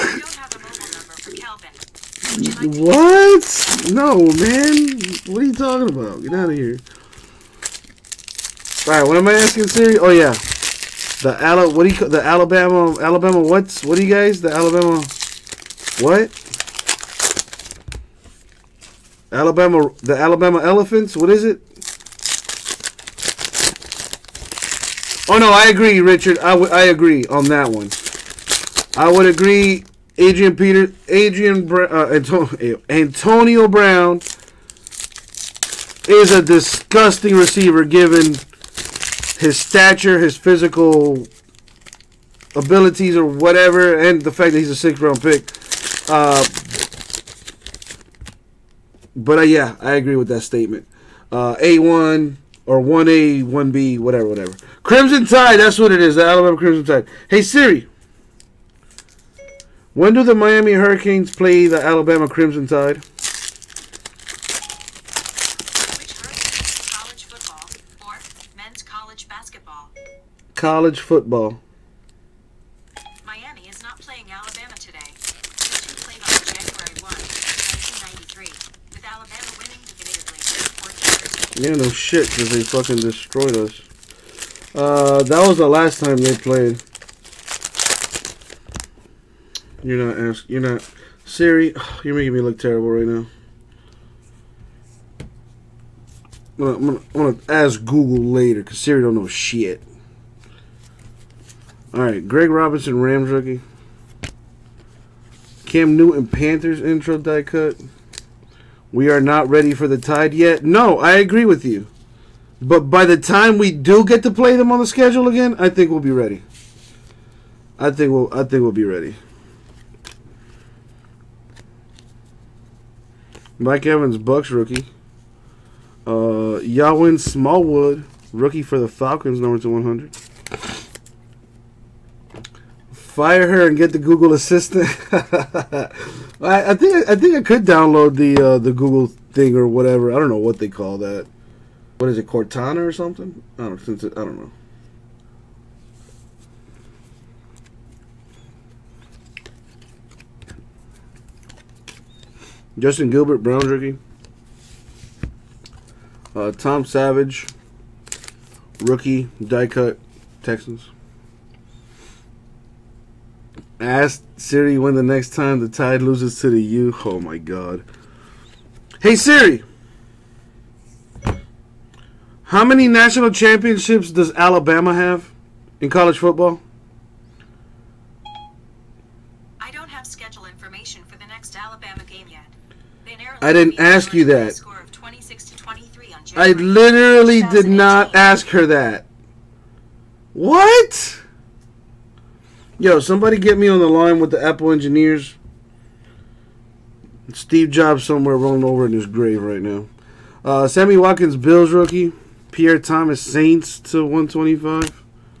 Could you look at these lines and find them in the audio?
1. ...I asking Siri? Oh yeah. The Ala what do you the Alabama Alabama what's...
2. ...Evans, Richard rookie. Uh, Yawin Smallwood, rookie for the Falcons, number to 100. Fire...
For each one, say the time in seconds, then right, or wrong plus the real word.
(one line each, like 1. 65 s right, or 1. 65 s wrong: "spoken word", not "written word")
1. 9 s right
2. 123 s wrong: "Bucks", not "Richard".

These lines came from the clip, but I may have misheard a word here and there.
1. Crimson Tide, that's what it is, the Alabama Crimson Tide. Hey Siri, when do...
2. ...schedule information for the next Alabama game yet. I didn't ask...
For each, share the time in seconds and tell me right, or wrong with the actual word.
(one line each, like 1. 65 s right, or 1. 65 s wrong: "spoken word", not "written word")
1. 54 s right
2. 180 s right.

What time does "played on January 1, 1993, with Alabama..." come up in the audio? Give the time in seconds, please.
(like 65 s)
75 s.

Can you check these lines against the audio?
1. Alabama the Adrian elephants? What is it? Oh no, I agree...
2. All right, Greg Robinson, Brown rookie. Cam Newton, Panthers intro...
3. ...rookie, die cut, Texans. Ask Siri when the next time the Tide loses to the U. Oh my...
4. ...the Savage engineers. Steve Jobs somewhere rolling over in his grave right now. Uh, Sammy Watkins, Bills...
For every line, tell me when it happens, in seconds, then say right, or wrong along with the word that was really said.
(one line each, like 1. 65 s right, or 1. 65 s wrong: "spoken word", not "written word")
1. 19 s wrong: "Alabama", not "Adrian"
2. 101 s wrong: "Rams", not "Brown"
3. 158 s right
4. 194 s wrong: "Apple", not "Savage".